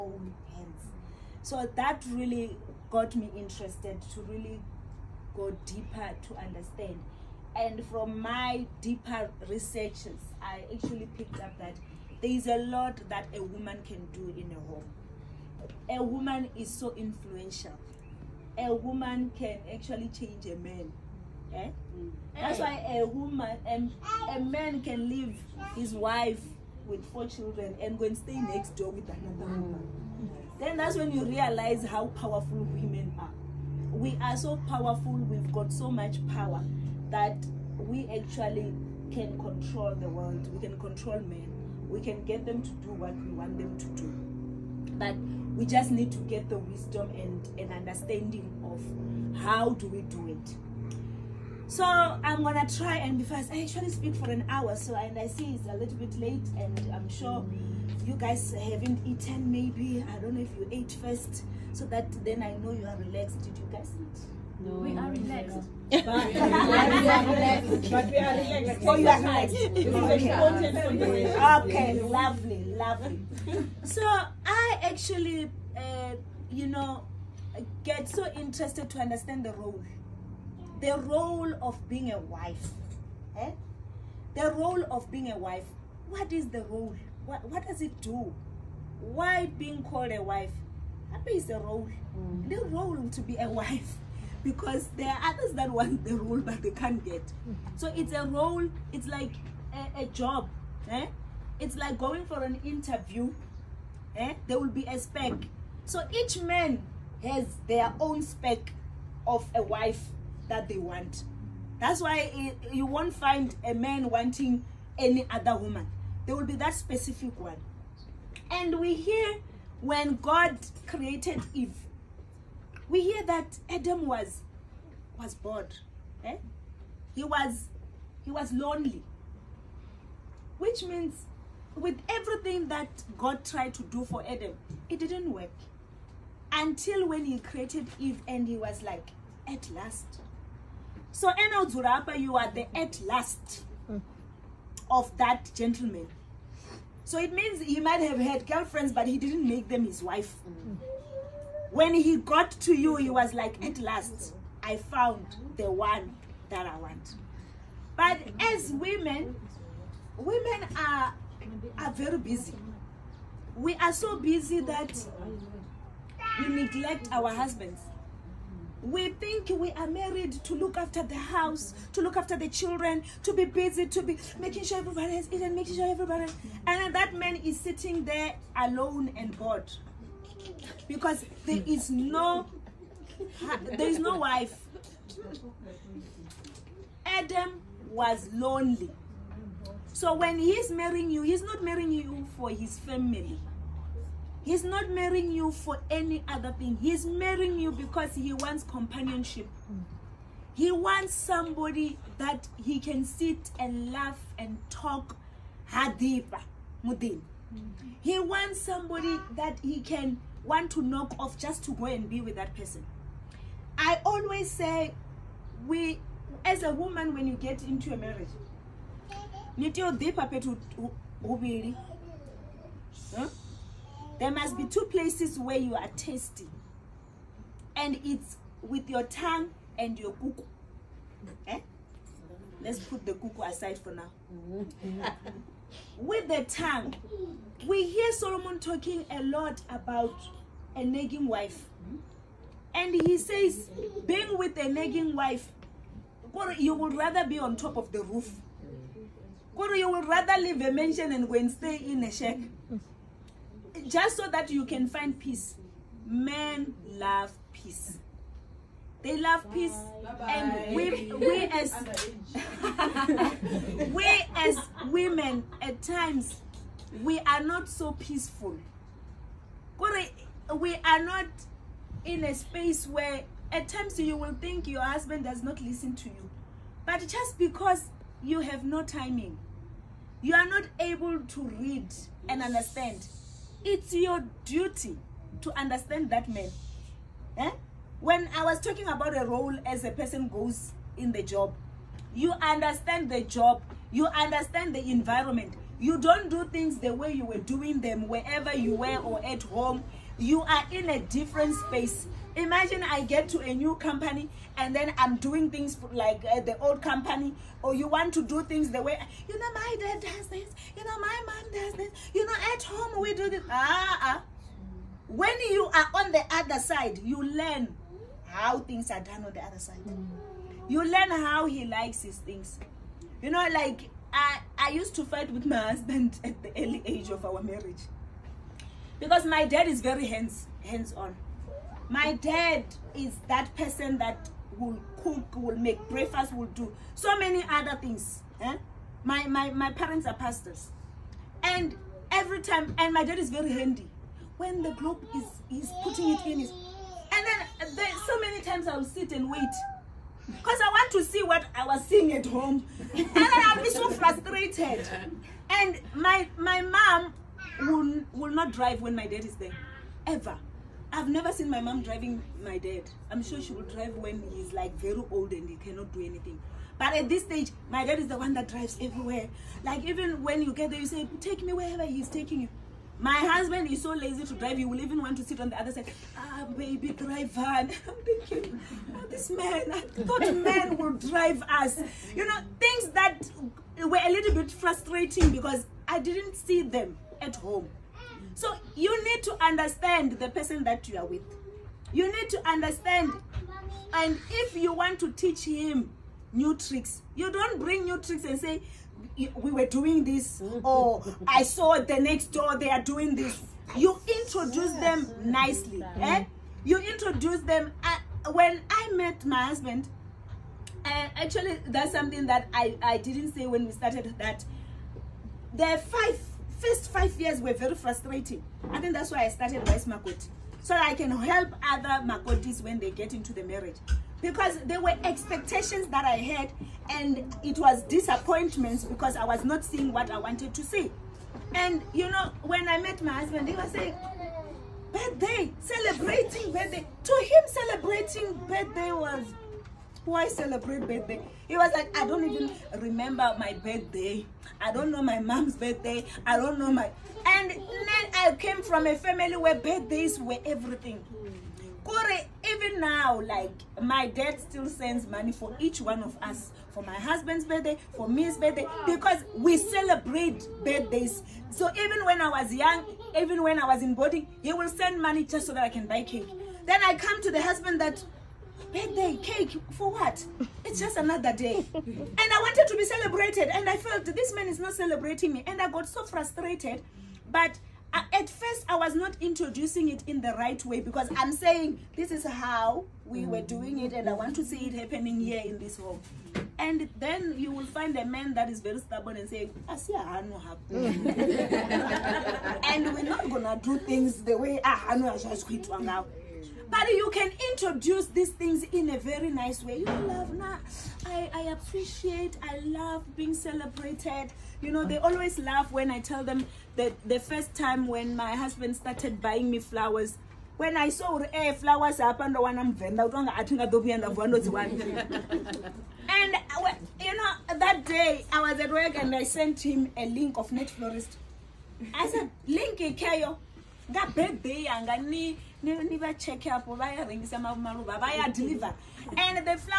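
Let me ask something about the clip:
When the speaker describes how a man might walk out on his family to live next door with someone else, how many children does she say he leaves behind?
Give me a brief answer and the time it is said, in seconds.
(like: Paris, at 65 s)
4, at 27 s.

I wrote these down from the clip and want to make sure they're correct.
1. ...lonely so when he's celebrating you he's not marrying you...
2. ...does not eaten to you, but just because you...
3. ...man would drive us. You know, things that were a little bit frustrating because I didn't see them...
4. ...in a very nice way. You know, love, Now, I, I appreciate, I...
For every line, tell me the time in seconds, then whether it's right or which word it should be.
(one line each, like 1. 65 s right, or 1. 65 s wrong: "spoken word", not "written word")
1. 188 s wrong: "marrying", not "celebrating"
2. 275 s wrong: "listen", not "eaten"
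3. 380 s right
4. 498 s right.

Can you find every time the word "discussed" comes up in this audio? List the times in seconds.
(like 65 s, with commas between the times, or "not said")
not said.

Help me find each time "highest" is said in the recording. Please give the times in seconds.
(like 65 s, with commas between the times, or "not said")
not said.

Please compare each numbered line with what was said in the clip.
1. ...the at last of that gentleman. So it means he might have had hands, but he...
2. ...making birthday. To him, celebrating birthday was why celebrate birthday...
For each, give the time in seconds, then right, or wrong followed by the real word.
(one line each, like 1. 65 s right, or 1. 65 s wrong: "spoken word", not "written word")
1. 142 s wrong: "girlfriends", not "hands"
2. 435 s wrong: "celebrating", not "making".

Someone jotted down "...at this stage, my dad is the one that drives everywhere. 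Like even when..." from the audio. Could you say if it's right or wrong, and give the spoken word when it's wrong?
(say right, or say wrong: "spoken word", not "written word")
right.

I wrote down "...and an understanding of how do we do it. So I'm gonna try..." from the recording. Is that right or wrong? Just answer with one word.
right.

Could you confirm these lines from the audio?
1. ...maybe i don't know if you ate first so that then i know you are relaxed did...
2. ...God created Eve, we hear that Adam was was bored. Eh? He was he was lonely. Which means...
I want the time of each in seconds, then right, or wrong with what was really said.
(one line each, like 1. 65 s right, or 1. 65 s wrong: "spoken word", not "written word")
1. 59 s right
2. 120 s right.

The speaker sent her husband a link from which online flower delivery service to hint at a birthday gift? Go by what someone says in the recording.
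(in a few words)
Net Florist.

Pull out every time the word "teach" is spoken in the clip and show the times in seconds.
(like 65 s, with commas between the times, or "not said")
395 s.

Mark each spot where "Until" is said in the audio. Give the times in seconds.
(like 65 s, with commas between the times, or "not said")
136 s.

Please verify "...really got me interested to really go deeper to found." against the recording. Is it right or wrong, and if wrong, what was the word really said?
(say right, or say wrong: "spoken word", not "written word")
wrong: "understand", not "found".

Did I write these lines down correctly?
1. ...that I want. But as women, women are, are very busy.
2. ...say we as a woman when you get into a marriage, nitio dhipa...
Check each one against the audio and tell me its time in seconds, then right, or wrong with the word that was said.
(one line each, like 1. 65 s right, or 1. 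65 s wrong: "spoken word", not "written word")
1. 156 s right
2. 214 s right.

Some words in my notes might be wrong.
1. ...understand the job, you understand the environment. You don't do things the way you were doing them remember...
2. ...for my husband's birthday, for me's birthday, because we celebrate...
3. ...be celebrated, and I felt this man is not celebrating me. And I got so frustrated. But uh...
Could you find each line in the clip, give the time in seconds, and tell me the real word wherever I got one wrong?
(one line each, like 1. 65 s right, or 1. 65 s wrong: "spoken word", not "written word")
1. 292 s wrong: "wherever", not "remember"
2. 456 s right
3. 472 s right.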